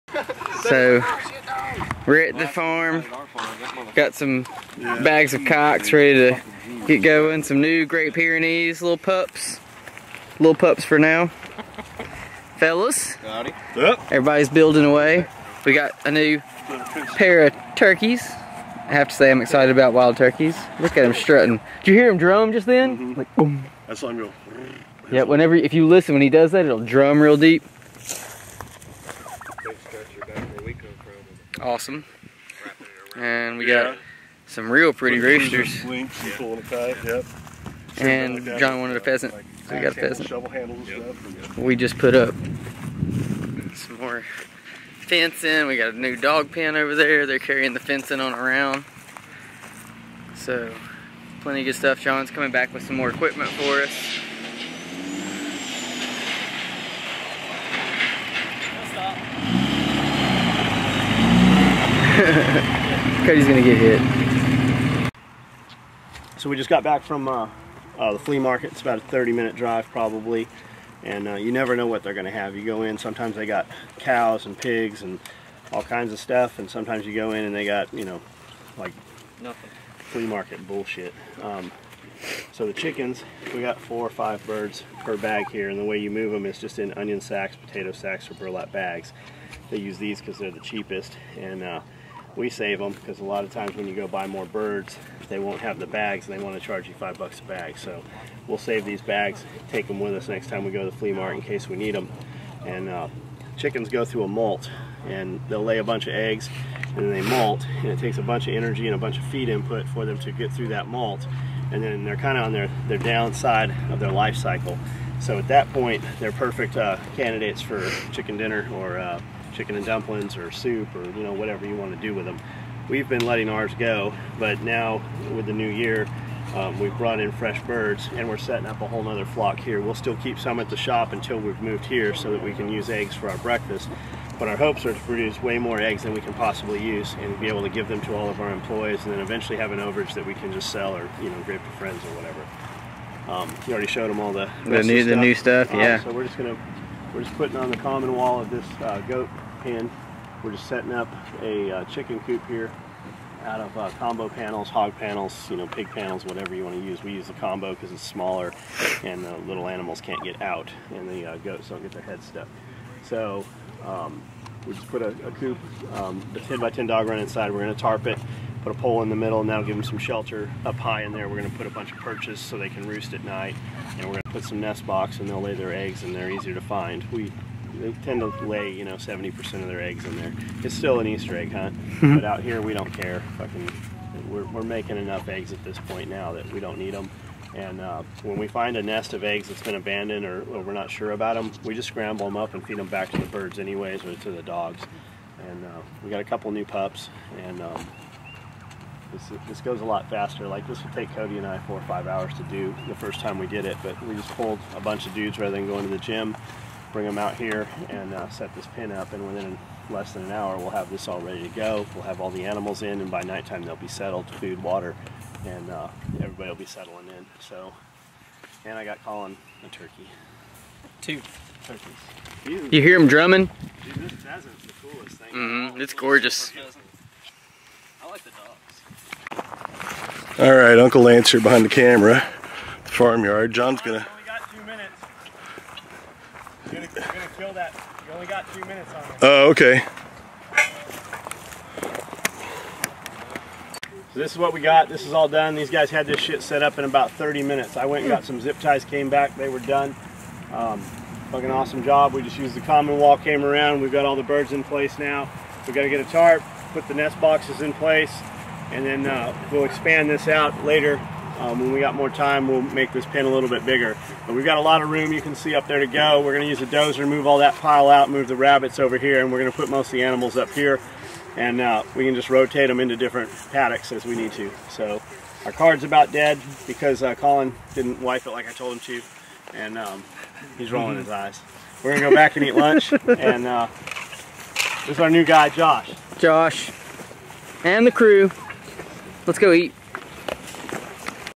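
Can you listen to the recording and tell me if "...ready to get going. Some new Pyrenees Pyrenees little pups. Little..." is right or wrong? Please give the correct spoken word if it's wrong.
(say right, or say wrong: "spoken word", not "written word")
wrong: "Great", not "Pyrenees".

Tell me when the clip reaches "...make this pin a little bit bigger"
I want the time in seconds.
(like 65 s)
262 s.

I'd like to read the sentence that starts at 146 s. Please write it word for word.
So we're just going to, we're just putting on the common wall of this uh, goat pen.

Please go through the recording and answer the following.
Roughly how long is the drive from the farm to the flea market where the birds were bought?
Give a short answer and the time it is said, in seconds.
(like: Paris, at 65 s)
30 minutes, at 69 s.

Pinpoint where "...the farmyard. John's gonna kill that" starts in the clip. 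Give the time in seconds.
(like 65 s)
232 s.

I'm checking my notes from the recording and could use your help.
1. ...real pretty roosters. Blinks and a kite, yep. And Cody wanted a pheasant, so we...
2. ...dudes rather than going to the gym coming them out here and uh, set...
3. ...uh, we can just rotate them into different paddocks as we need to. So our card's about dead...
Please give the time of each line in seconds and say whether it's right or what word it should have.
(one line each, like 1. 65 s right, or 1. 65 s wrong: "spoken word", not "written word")
1. 34 s wrong: "John", not "Cody"
2. 205 s wrong: "bring", not "coming"
3. 271 s right.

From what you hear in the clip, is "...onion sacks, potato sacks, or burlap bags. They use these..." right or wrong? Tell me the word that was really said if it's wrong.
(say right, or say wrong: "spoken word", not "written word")
right.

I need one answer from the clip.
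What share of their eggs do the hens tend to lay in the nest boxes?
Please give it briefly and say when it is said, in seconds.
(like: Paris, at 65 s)
70%, at 178 s.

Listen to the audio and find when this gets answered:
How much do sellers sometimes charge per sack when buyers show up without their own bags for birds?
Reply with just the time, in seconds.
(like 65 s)
96 s.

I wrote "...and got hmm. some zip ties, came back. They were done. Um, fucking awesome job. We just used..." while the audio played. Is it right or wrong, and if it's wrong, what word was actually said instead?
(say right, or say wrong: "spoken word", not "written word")
right.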